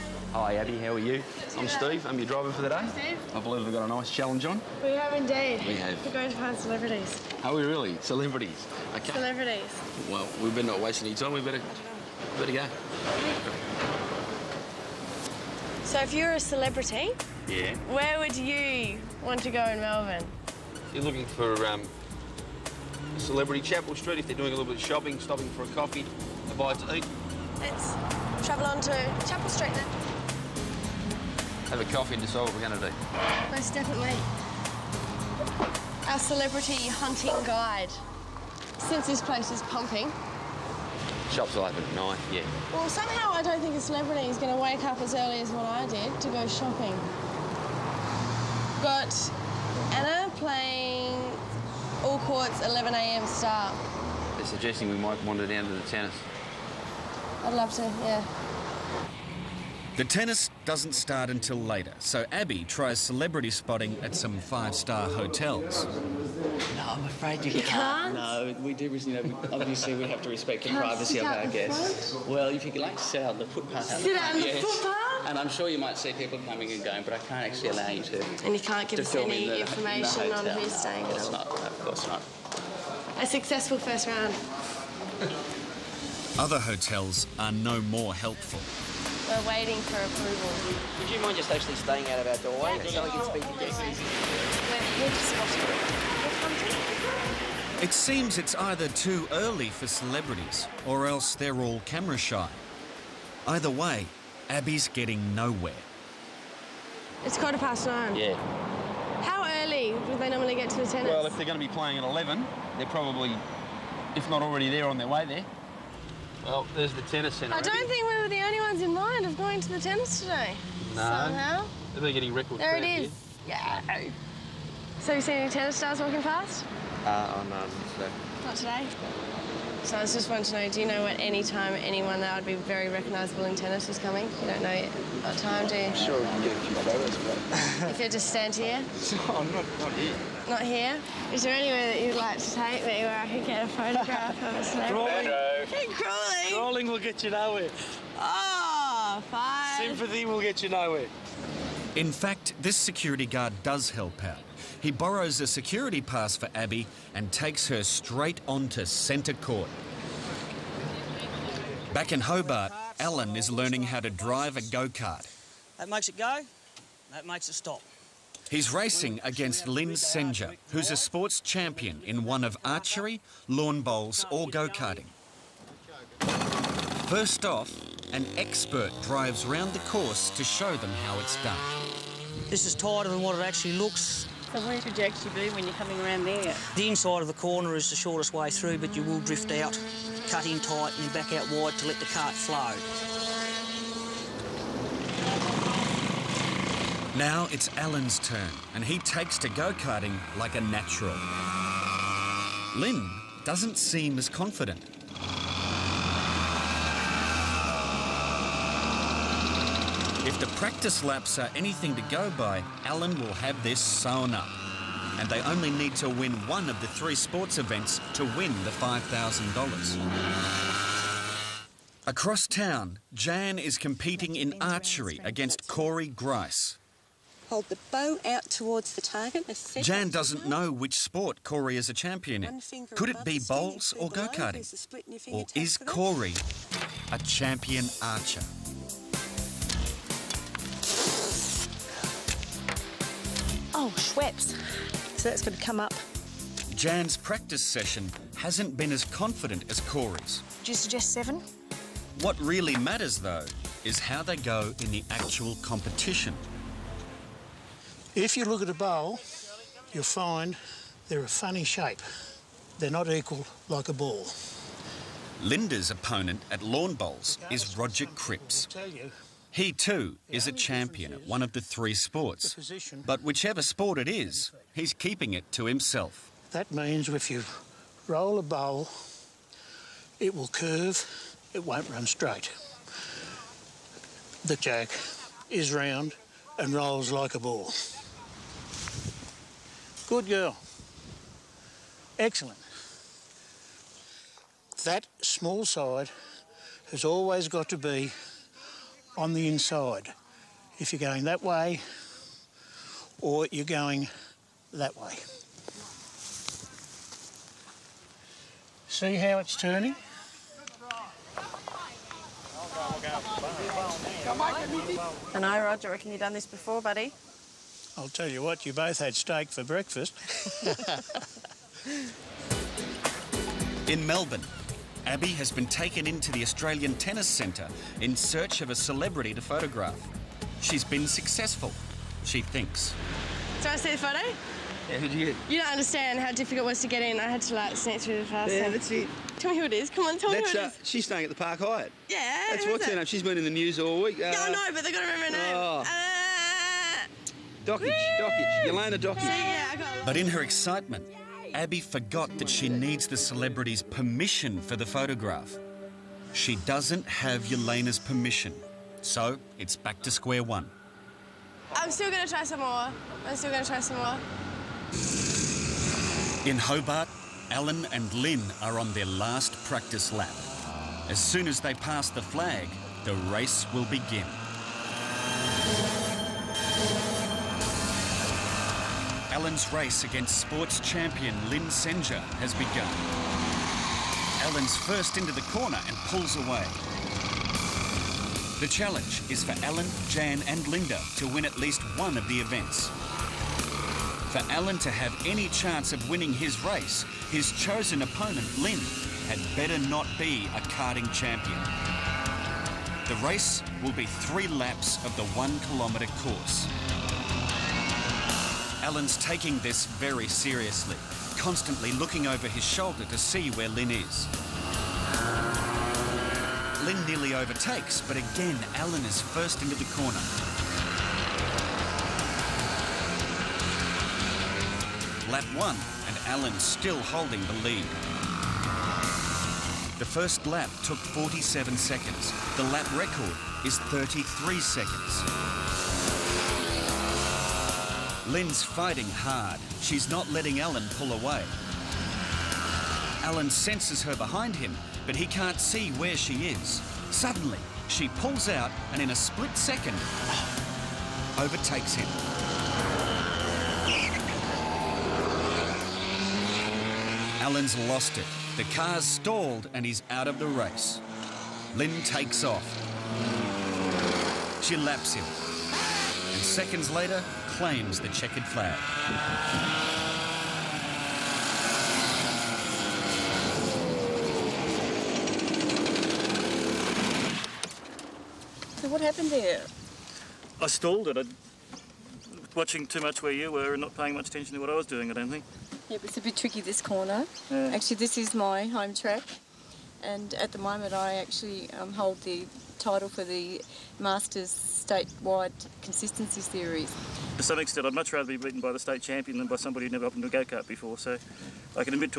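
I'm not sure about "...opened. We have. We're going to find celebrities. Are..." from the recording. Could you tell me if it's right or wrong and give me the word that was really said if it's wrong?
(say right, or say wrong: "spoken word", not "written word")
wrong: "indeed", not "opened".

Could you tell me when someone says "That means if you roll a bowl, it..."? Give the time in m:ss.
4:36.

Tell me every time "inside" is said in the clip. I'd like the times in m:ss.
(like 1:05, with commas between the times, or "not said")
3:06, 4:59.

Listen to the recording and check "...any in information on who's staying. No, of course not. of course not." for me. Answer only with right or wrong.
right.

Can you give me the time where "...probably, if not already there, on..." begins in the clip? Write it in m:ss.
1:52.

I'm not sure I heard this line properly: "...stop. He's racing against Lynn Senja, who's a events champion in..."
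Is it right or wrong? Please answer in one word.
wrong.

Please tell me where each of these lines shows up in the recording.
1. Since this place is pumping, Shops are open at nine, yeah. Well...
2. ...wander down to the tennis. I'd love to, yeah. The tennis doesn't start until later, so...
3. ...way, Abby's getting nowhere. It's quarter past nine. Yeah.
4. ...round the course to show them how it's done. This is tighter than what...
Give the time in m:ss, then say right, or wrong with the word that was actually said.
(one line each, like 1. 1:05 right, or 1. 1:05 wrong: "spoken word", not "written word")
1. 0:38 right
2. 0:55 right
3. 1:43 right
4. 2:59 right.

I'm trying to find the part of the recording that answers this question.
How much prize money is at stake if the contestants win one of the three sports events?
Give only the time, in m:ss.
3:38.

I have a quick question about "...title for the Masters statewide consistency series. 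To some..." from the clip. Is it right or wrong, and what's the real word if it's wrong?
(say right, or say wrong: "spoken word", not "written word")
right.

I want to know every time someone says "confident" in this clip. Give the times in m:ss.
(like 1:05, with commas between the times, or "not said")
3:24, 4:09.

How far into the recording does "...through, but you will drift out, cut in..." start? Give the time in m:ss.
3:08.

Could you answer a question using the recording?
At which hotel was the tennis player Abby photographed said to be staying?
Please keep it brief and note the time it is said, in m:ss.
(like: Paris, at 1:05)
Park Hyatt, at 5:41.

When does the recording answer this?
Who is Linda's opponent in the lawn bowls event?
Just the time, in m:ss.
4:27.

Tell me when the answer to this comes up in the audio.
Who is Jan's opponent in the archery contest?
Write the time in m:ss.
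3:45.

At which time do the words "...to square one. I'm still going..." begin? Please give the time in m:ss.
6:00.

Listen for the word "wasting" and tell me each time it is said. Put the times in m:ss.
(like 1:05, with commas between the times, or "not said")
0:10.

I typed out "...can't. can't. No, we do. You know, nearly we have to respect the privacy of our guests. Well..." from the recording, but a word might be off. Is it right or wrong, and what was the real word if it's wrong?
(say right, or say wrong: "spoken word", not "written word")
wrong: "obviously", not "nearly".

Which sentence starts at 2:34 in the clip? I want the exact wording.
He borrows a security pass for Abby and takes her straight onto centre court.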